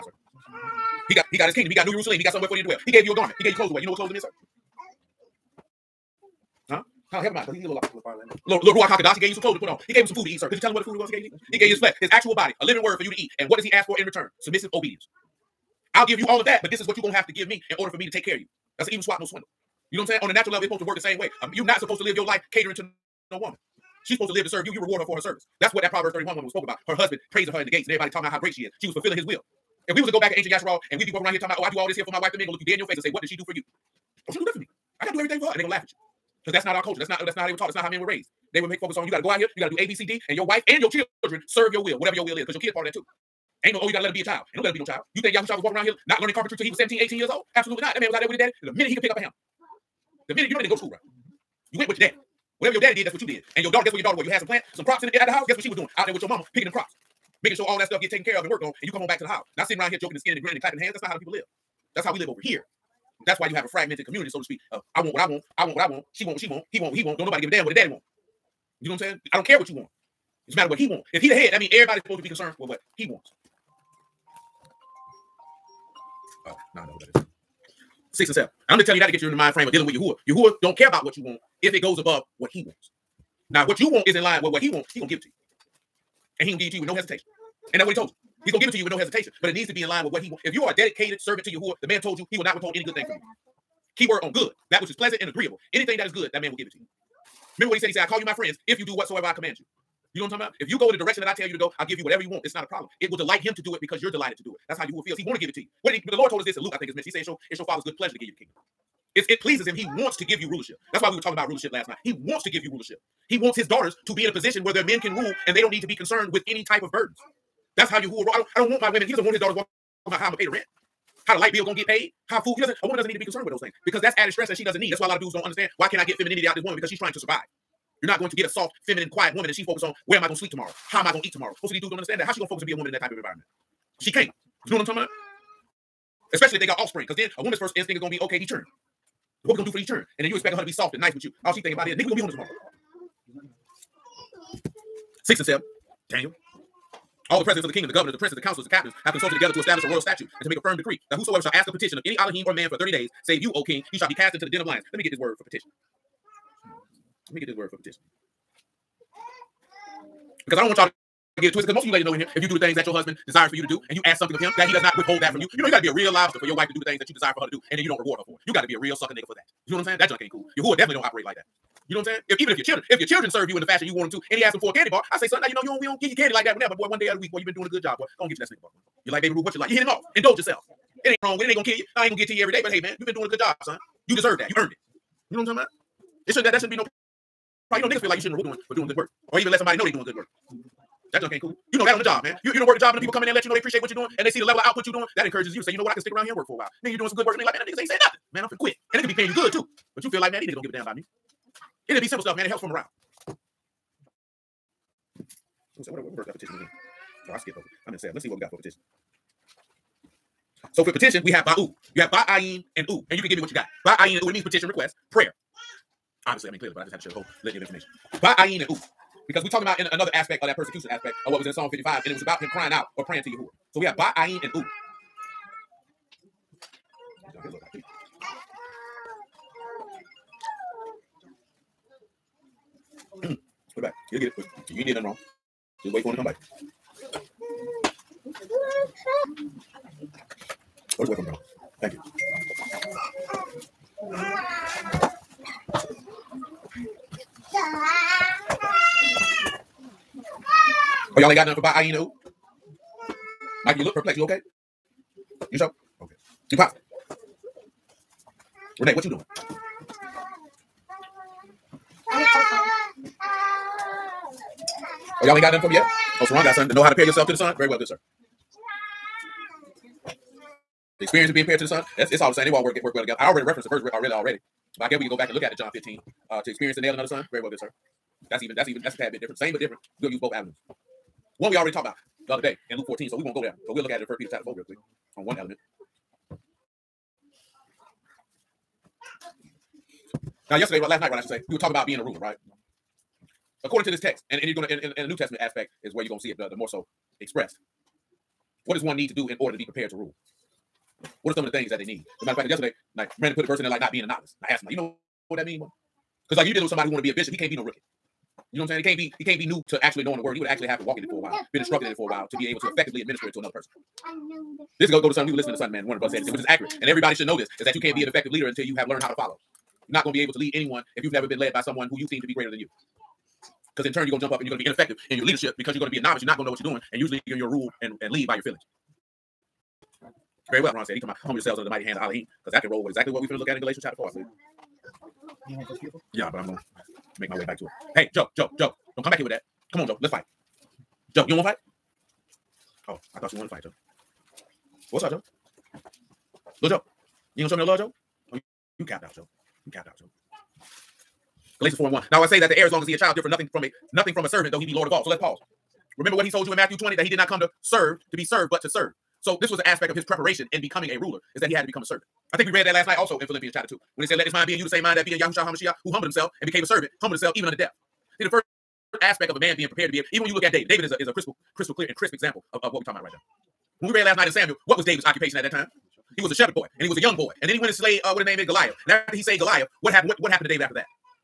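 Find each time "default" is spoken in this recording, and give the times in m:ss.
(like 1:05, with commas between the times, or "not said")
not said.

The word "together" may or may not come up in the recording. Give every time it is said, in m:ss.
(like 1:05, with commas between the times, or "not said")
2:29, 4:33.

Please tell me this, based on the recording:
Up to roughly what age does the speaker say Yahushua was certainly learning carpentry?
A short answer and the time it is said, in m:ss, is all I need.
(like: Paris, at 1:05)
17, 18, at 0:46.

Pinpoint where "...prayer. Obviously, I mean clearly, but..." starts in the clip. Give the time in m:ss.
3:35.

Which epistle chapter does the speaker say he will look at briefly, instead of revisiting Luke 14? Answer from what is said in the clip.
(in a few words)
First Peter chapter 4.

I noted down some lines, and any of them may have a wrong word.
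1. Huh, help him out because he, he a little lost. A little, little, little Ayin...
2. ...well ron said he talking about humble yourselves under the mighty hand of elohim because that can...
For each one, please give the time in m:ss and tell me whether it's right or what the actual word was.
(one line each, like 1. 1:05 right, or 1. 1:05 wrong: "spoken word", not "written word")
1. 0:07 wrong: "Ruach", not "Ayin"
2. 5:30 right.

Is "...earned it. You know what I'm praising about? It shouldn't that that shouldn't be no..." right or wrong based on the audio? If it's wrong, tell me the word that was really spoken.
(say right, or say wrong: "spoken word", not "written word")
wrong: "talking", not "praising".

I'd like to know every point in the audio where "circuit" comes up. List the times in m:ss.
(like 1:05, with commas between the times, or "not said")
not said.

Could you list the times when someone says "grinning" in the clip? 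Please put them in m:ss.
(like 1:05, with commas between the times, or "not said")
1:00.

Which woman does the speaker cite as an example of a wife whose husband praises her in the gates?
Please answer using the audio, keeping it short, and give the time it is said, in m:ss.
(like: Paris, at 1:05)
Proverbs 31 woman, at 0:25.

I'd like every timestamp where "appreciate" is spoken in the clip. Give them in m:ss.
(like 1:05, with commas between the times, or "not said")
3:13.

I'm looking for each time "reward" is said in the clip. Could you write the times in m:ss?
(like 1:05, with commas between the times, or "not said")
0:24, 2:47, 3:08.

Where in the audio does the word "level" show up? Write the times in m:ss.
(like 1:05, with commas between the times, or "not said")
0:20, 3:14.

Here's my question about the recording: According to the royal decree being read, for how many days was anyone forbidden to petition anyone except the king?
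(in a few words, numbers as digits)
30.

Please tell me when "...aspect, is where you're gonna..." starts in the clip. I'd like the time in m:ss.
4:55.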